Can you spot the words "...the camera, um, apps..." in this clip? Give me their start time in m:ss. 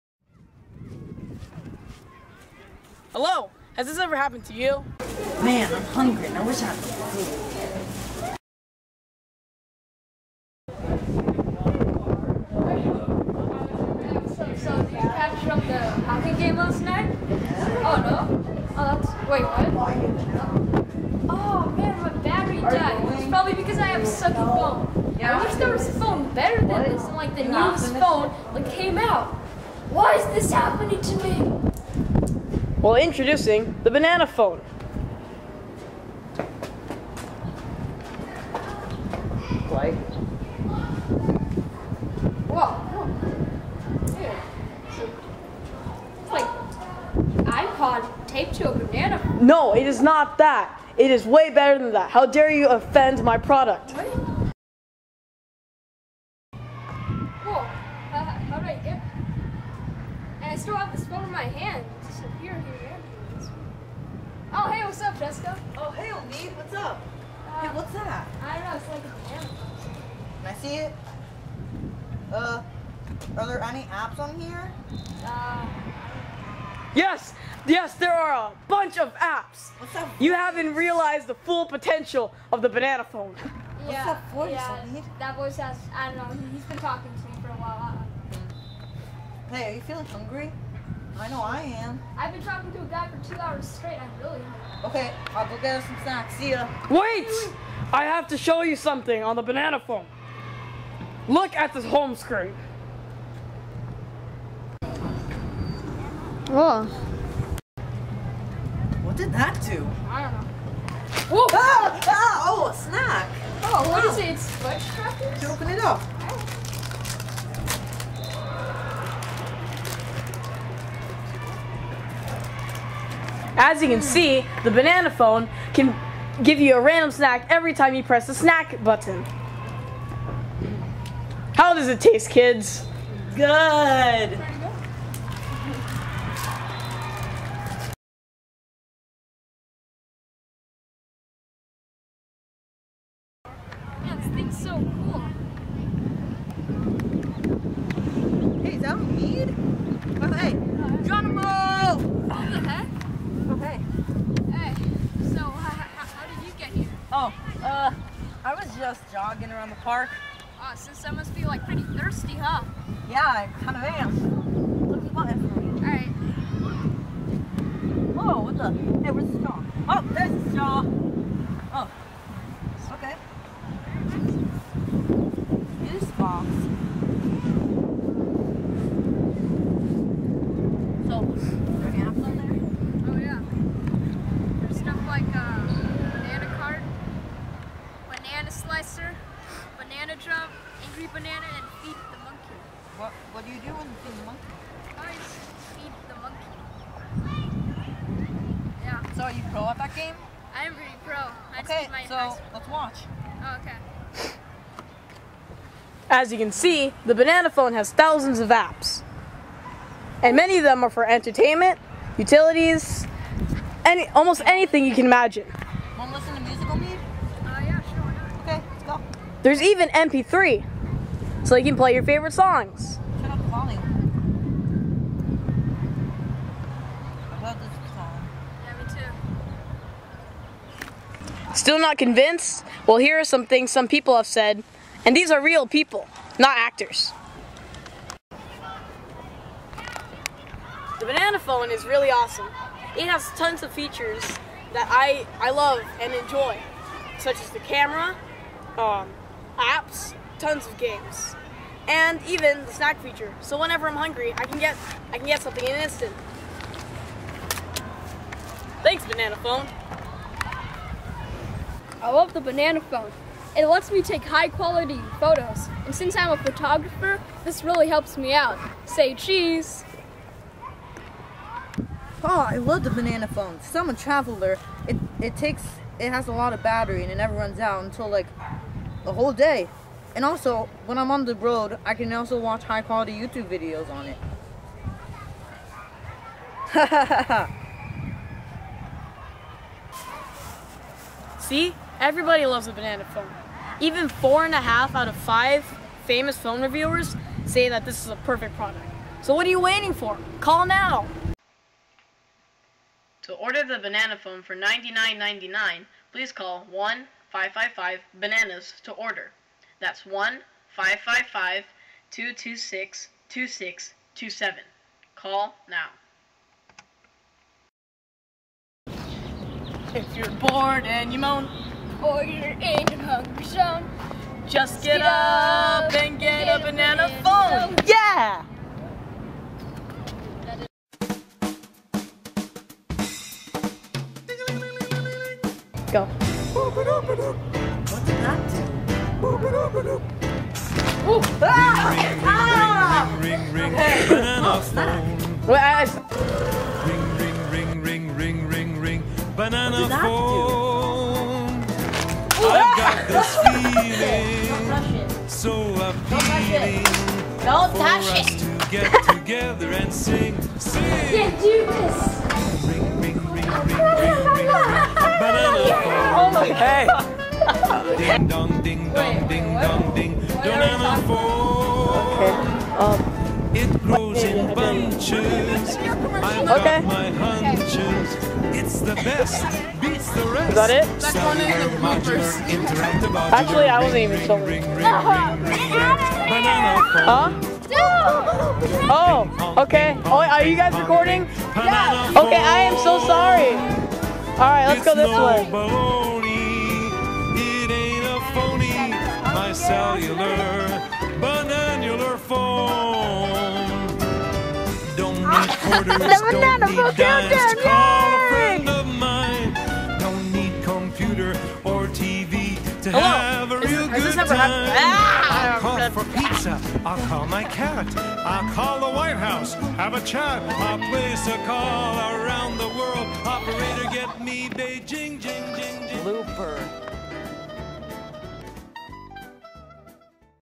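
4:07.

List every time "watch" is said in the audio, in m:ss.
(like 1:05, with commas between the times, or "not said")
3:22, 4:42.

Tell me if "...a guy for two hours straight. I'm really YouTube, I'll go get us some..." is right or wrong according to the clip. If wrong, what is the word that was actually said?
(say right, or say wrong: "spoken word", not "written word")
wrong: "Okay", not "YouTube".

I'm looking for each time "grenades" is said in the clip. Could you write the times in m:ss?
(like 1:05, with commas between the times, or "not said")
not said.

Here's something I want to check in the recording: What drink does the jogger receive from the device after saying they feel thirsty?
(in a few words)
juice box.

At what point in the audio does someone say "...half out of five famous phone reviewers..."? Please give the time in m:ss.
4:54.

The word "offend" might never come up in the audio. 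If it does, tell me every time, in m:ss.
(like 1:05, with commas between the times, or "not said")
0:52.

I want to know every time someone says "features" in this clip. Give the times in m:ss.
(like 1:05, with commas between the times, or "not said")
4:03, 4:13.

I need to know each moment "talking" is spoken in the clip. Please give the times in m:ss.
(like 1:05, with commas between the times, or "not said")
1:26, 1:32.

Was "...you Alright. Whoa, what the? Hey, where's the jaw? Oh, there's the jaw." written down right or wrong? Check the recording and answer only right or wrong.
right.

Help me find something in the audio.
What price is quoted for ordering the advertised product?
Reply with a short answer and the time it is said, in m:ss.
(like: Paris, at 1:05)
$99.99, at 5:04.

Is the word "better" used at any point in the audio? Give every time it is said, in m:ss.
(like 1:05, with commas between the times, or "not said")
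0:26, 0:51.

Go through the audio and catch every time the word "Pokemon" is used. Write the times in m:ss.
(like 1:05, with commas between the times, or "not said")
not said.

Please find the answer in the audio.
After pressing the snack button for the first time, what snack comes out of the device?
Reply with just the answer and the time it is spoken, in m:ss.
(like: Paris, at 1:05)
fudge crackers, at 1:54.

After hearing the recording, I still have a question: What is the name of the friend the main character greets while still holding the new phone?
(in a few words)
Jessica.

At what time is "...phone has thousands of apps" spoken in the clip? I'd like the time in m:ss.
3:27.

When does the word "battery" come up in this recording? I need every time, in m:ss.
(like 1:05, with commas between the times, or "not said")
0:22, 4:36.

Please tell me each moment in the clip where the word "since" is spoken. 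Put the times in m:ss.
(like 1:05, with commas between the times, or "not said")
2:40, 4:25, 4:33.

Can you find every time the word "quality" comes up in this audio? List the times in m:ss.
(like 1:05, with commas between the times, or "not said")
4:24, 4:42.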